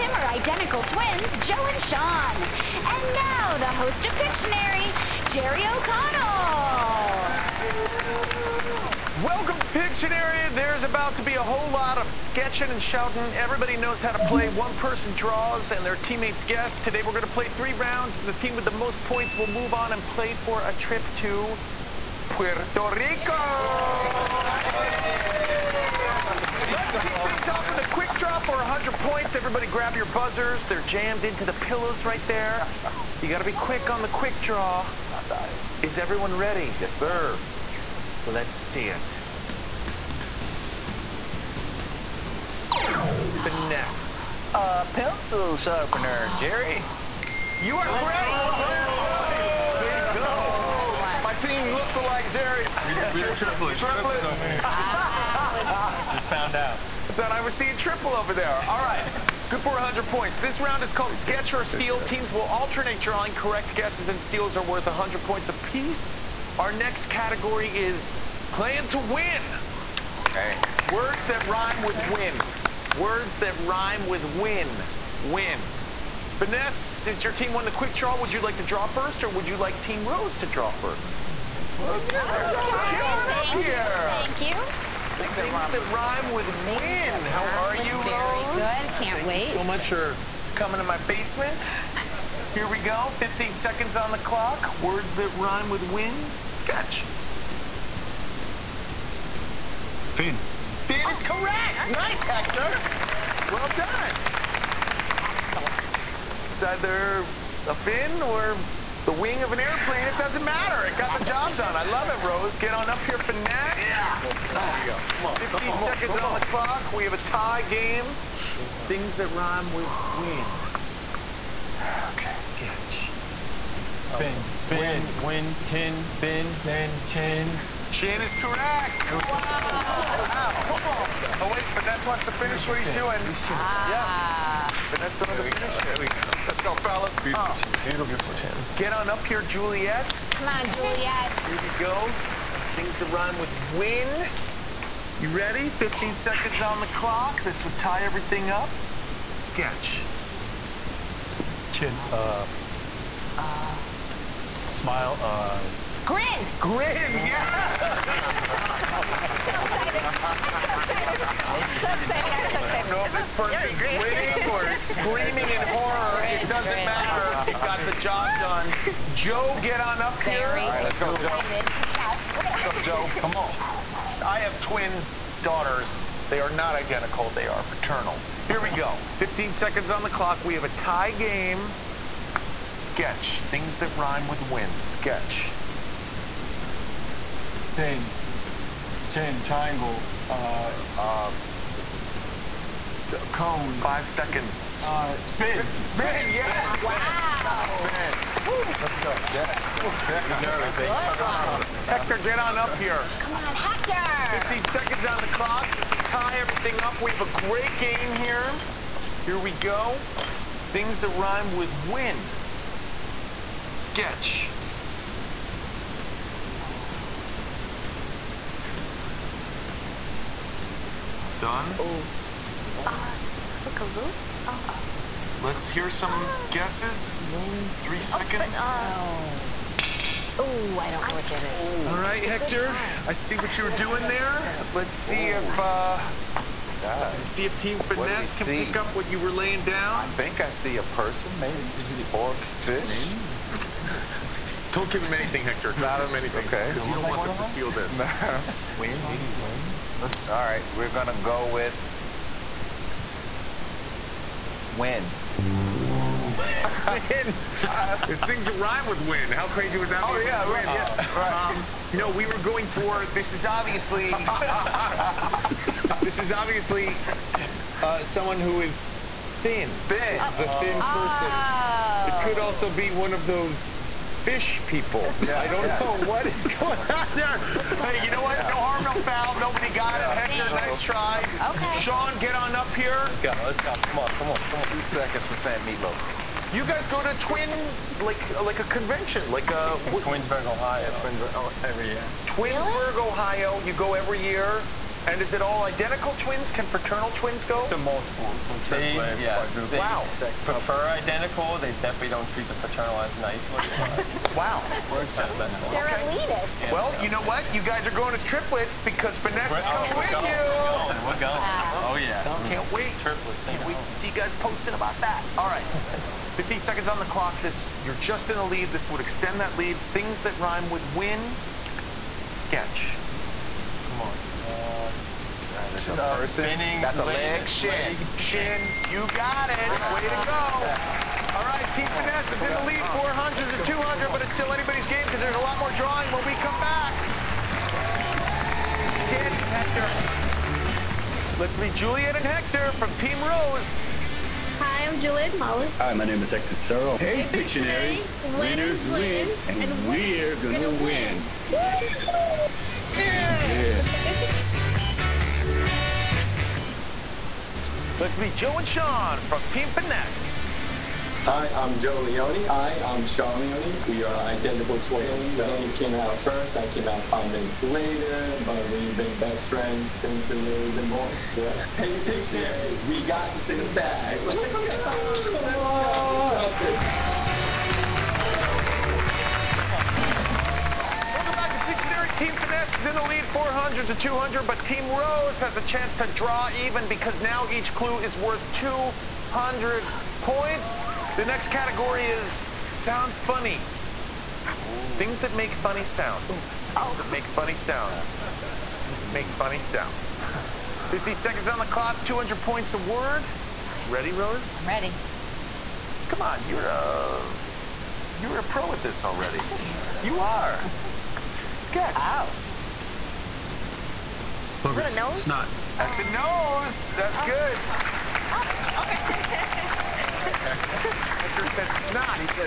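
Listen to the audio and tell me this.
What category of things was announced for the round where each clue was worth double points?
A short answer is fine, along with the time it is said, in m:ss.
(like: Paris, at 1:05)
sounds funny, at 6:32.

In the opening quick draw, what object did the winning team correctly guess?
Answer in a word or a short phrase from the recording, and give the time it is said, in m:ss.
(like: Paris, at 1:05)
pencil sharpener, at 0:44.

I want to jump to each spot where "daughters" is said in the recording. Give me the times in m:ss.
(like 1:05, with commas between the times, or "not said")
2:55.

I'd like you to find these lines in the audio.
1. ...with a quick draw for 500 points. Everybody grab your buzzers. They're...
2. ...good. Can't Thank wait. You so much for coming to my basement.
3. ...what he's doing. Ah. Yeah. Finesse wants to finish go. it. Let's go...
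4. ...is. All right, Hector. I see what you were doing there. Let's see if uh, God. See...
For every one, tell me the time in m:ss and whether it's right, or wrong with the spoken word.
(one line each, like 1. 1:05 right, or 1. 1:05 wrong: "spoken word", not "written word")
1. 0:27 wrong: "100", not "500"
2. 1:28 right
3. 2:12 right
4. 3:51 right.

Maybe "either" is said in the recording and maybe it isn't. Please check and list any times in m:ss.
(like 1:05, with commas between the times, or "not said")
1:46.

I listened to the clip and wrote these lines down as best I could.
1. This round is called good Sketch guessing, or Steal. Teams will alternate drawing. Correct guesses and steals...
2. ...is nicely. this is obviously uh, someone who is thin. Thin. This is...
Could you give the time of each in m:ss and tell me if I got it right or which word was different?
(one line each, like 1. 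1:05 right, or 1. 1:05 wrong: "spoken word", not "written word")
1. 1:00 right
2. 4:23 wrong: "obviously", not "nicely".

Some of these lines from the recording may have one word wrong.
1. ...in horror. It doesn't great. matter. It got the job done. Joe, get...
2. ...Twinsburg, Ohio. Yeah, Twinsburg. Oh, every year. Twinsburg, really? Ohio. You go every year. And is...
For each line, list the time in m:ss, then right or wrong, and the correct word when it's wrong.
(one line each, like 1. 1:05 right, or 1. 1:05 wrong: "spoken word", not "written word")
1. 2:45 right
2. 4:50 right.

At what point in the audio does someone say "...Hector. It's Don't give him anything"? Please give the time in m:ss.
4:05.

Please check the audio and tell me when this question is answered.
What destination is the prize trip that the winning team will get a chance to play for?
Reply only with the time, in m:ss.
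0:22.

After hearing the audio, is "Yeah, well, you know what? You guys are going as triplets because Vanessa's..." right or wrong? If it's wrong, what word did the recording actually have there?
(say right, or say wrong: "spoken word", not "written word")
right.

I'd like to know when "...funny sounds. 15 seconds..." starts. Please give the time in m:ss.
6:39.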